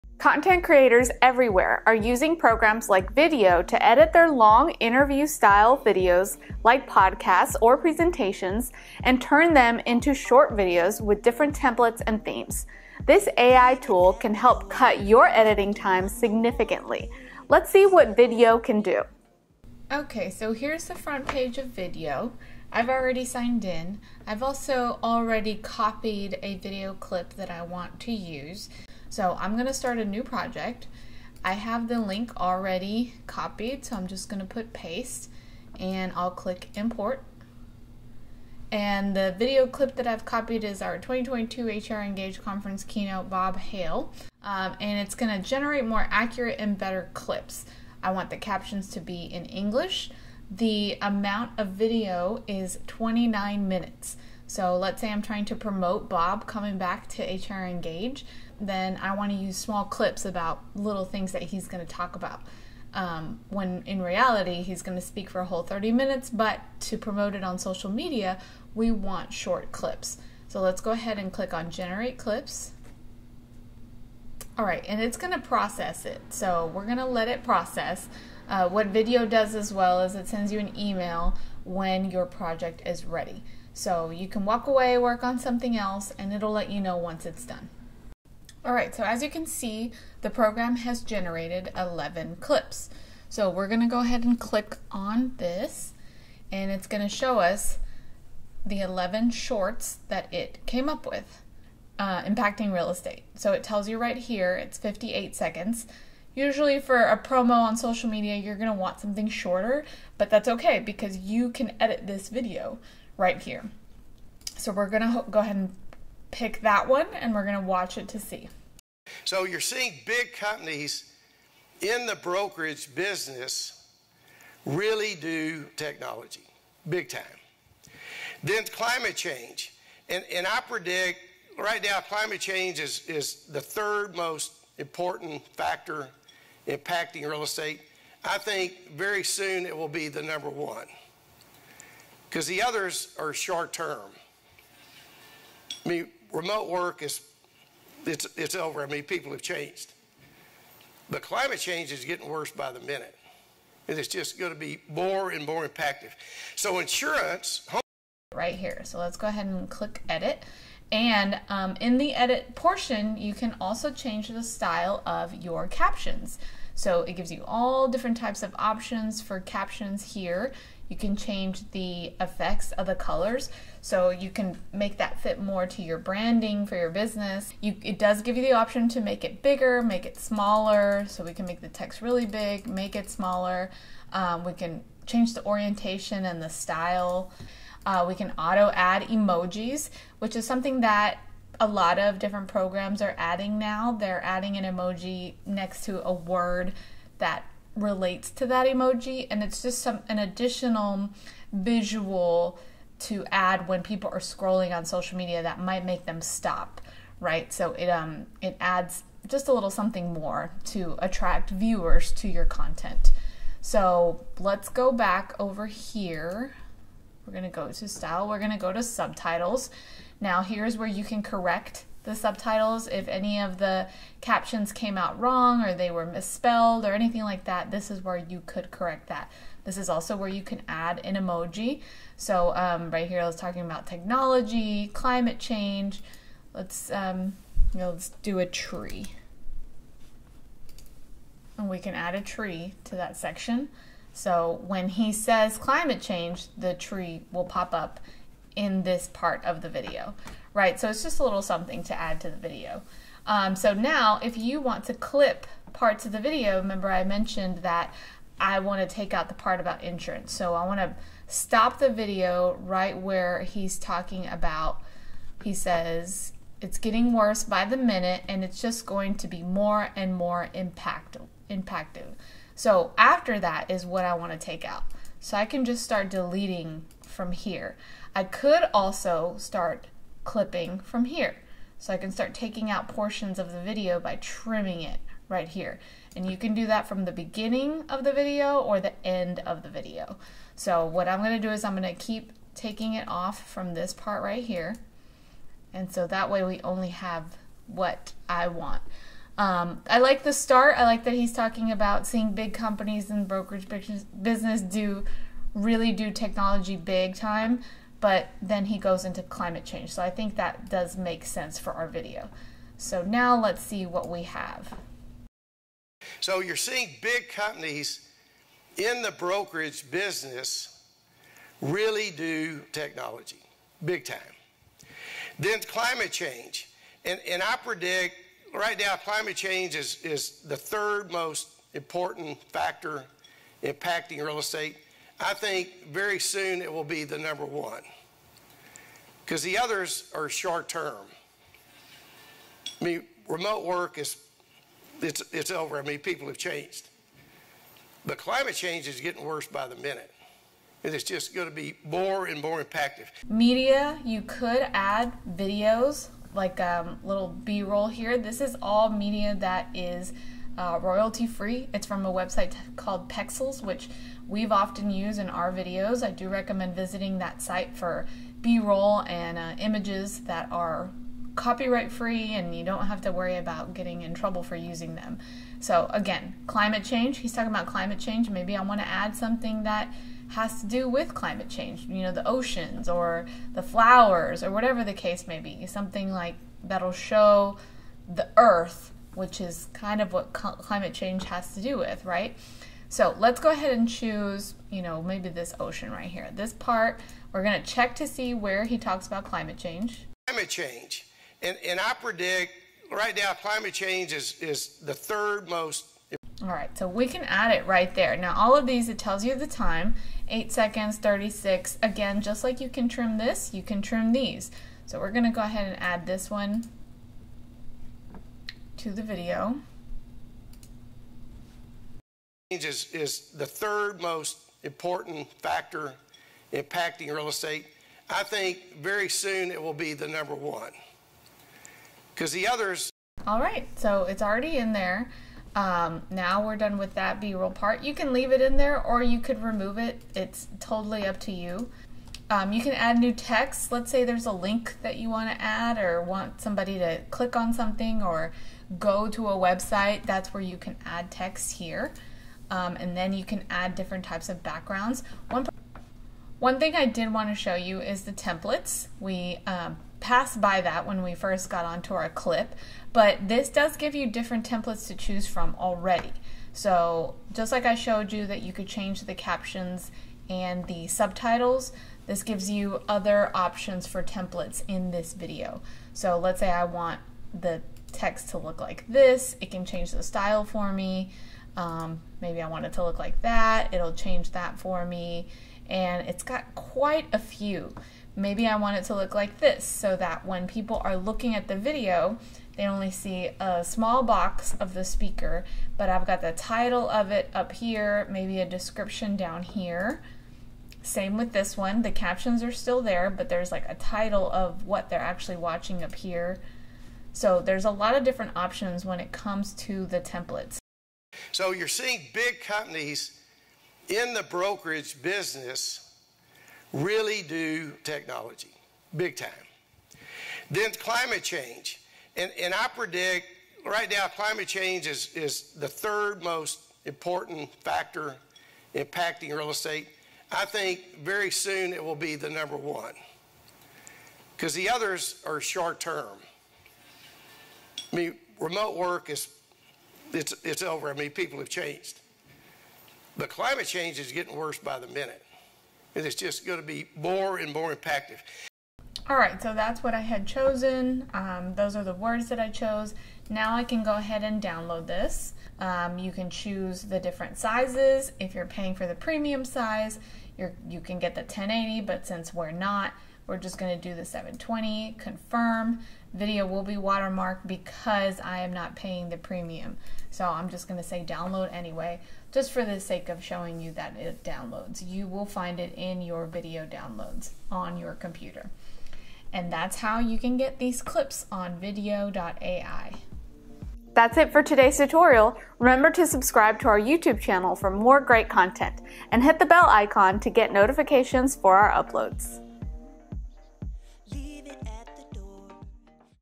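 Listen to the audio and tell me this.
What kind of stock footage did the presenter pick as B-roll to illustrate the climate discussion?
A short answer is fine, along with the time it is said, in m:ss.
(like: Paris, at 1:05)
ocean, at 6:35.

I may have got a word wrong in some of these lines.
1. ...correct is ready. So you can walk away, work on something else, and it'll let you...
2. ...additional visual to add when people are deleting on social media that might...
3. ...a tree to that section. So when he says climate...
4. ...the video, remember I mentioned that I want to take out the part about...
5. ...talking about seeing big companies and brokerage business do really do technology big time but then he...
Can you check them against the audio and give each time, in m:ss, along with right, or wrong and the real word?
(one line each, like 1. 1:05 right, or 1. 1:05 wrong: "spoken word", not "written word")
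1. 1:22 wrong: "project", not "correct"
2. 3:20 wrong: "scrolling", not "deleting"
3. 4:02 right
4. 4:16 right
5. 5:01 right.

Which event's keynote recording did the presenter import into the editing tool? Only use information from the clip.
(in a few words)
2022 HR Engage Conference.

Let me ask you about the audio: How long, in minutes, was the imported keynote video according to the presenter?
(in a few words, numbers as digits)
29.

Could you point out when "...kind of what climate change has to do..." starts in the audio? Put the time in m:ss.
6:29.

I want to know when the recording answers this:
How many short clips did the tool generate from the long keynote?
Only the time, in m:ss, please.
1:31.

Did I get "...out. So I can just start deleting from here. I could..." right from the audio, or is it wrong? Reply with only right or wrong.
right.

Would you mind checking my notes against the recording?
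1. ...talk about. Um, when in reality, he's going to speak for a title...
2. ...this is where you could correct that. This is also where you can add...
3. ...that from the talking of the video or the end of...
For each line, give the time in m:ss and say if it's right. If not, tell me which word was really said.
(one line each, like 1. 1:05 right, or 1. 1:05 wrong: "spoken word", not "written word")
1. 1:01 wrong: "whole", not "title"
2. 3:47 right
3. 4:46 wrong: "beginning", not "talking".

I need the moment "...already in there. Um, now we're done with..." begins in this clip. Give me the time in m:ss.
7:14.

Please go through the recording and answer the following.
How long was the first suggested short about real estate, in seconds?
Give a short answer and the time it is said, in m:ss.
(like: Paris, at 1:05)
58, at 1:44.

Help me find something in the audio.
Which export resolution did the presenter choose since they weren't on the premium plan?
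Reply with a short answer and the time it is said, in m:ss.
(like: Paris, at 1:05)
720, at 9:24.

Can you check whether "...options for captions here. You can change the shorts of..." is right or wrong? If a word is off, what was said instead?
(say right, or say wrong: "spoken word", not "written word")
wrong: "effects", not "shorts".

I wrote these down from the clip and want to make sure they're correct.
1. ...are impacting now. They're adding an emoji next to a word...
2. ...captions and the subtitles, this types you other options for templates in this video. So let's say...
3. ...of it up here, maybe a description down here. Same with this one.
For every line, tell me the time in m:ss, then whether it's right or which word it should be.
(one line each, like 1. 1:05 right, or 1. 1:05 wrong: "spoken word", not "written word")
1. 3:13 wrong: "adding", not "impacting"
2. 7:49 wrong: "gives", not "types"
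3. 8:16 right.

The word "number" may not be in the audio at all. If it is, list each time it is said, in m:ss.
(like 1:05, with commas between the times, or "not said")
2:20, 5:37, 7:10, 8:52.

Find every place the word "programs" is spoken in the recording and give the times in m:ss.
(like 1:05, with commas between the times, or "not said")
0:02, 1:30, 3:12.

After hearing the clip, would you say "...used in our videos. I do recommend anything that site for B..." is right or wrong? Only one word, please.
wrong.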